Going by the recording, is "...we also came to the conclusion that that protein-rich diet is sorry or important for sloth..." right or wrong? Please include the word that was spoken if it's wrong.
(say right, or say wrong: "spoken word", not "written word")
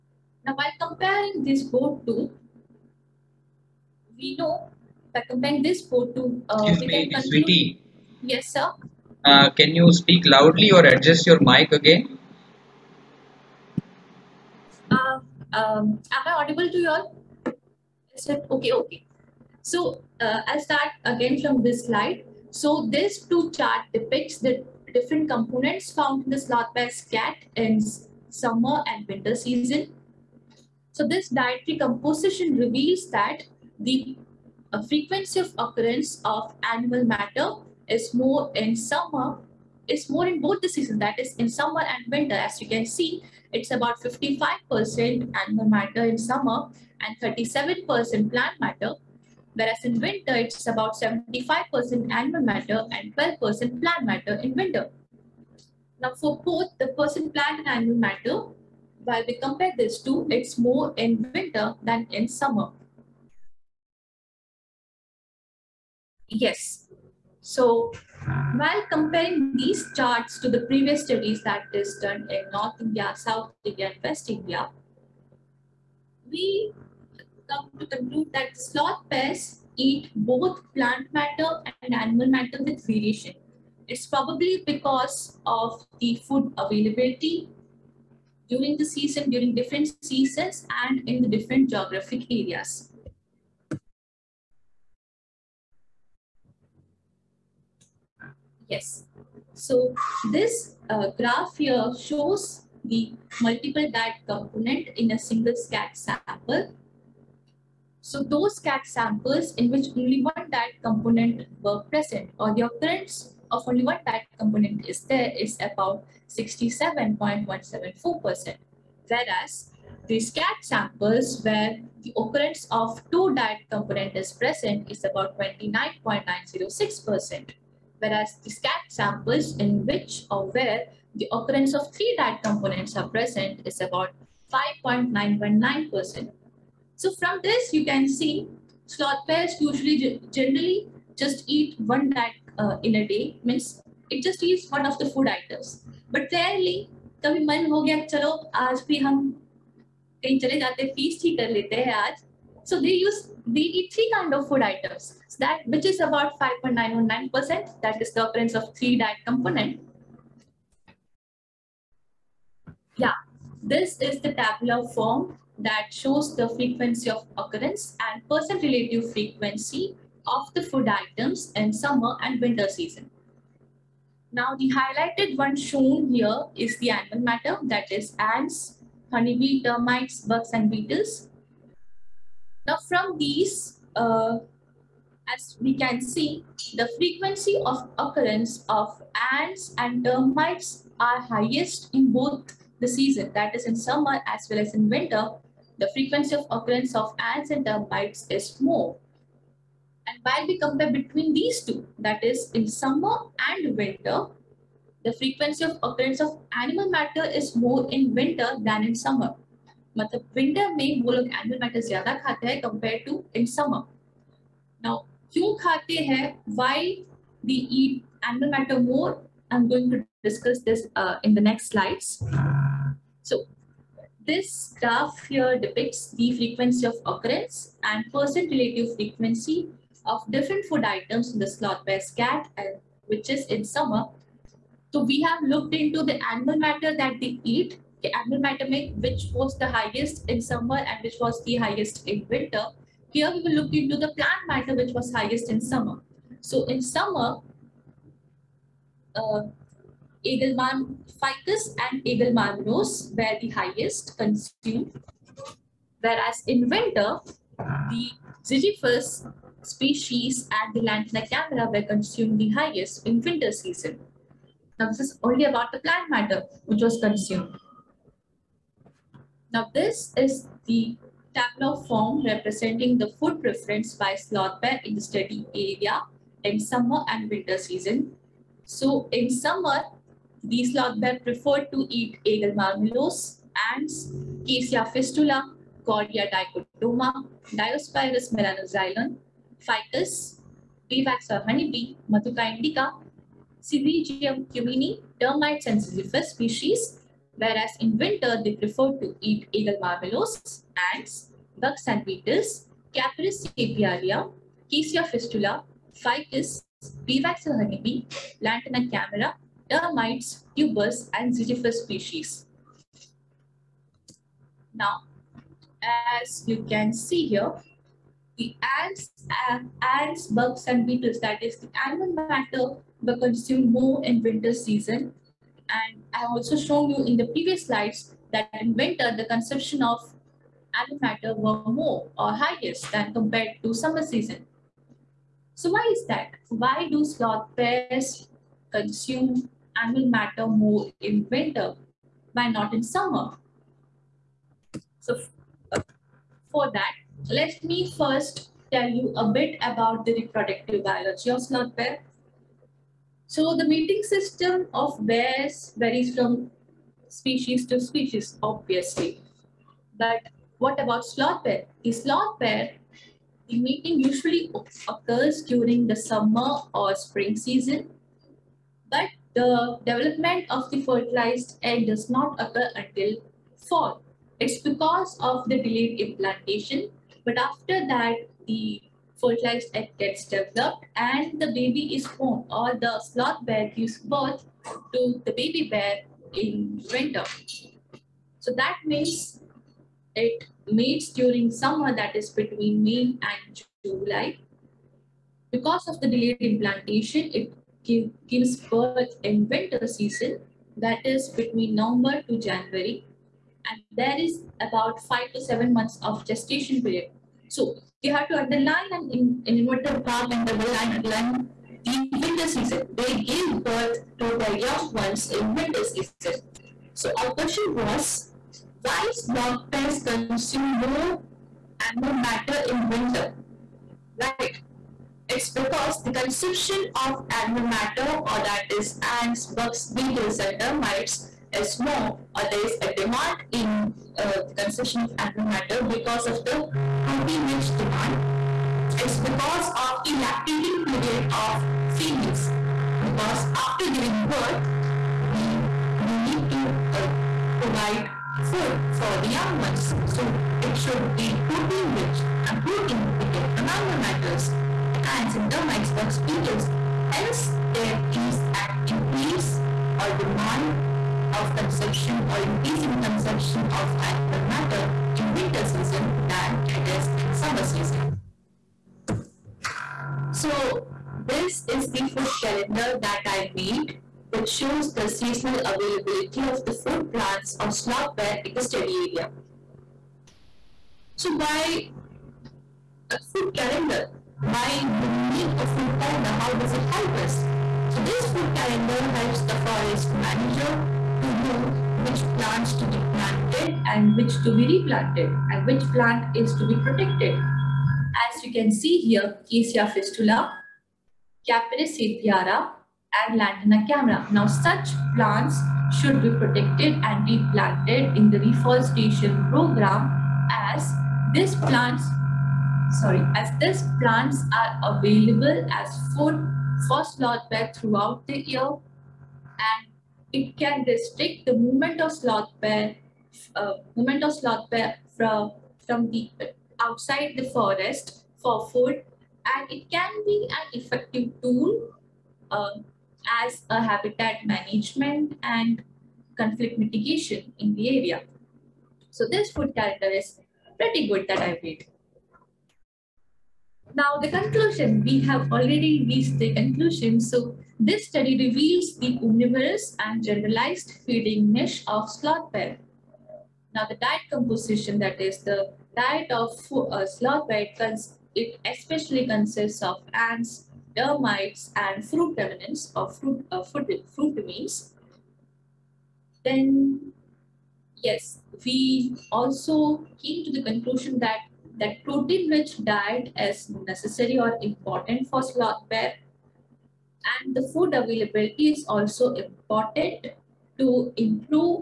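wrong: "necessary", not "sorry".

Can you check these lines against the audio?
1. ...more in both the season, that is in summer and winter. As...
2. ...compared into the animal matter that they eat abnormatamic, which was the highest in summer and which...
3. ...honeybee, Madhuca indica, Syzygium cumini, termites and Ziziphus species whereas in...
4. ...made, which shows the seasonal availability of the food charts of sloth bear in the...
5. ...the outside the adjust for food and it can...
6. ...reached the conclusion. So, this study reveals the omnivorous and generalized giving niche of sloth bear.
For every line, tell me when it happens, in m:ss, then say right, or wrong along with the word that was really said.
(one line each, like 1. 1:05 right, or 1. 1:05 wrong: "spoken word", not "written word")
1. 0:40 right
2. 3:55 wrong: "looked", not "compared"
3. 4:51 right
4. 7:53 wrong: "plants", not "charts"
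5. 8:46 wrong: "forest", not "adjust"
6. 9:06 wrong: "feeding", not "giving".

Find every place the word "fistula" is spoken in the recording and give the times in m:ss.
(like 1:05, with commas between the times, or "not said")
4:44, 5:05, 8:19.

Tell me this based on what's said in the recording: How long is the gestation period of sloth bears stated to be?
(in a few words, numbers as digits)
5 to 7 months.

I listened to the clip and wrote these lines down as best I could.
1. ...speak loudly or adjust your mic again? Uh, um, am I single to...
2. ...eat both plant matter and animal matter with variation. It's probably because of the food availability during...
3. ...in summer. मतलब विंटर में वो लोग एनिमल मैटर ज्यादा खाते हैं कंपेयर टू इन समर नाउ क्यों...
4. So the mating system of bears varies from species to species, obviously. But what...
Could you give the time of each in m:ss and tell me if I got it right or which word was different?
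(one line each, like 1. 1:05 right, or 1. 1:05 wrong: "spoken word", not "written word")
1. 0:09 wrong: "audible", not "single"
2. 1:19 right
3. 3:28 right
4. 5:53 right.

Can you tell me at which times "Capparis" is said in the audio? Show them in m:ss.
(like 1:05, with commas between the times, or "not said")
5:02, 8:21.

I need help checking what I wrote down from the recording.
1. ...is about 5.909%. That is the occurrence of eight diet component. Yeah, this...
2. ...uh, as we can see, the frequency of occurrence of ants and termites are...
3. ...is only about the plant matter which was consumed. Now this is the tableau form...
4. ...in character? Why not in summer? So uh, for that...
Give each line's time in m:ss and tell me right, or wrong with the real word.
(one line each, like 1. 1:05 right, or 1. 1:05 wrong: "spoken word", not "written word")
1. 2:35 wrong: "three", not "eight"
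2. 3:03 right
3. 4:24 right
4. 5:41 wrong: "winter", not "character".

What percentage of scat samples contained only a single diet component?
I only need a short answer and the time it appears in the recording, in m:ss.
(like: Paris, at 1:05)
67.174%, at 1:56.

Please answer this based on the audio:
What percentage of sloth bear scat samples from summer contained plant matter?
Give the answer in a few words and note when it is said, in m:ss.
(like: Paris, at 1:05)
37%, at 0:47.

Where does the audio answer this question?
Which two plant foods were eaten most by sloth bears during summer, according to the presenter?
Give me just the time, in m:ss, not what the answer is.
4:10.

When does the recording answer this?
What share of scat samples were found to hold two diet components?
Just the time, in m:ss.
2:05.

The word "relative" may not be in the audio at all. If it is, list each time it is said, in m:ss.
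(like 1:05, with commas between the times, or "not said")
2:48, 3:48.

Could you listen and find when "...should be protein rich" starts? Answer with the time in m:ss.
7:30.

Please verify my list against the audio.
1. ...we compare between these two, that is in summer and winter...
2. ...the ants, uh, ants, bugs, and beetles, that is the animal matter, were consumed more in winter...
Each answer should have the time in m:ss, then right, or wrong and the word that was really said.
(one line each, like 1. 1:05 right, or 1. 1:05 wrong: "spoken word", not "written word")
1. 3:20 right
2. 5:18 right.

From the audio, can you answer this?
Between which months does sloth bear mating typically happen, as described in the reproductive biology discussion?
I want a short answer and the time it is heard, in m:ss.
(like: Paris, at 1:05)
May and July, at 6:32.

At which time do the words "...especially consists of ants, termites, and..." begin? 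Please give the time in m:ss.
9:18.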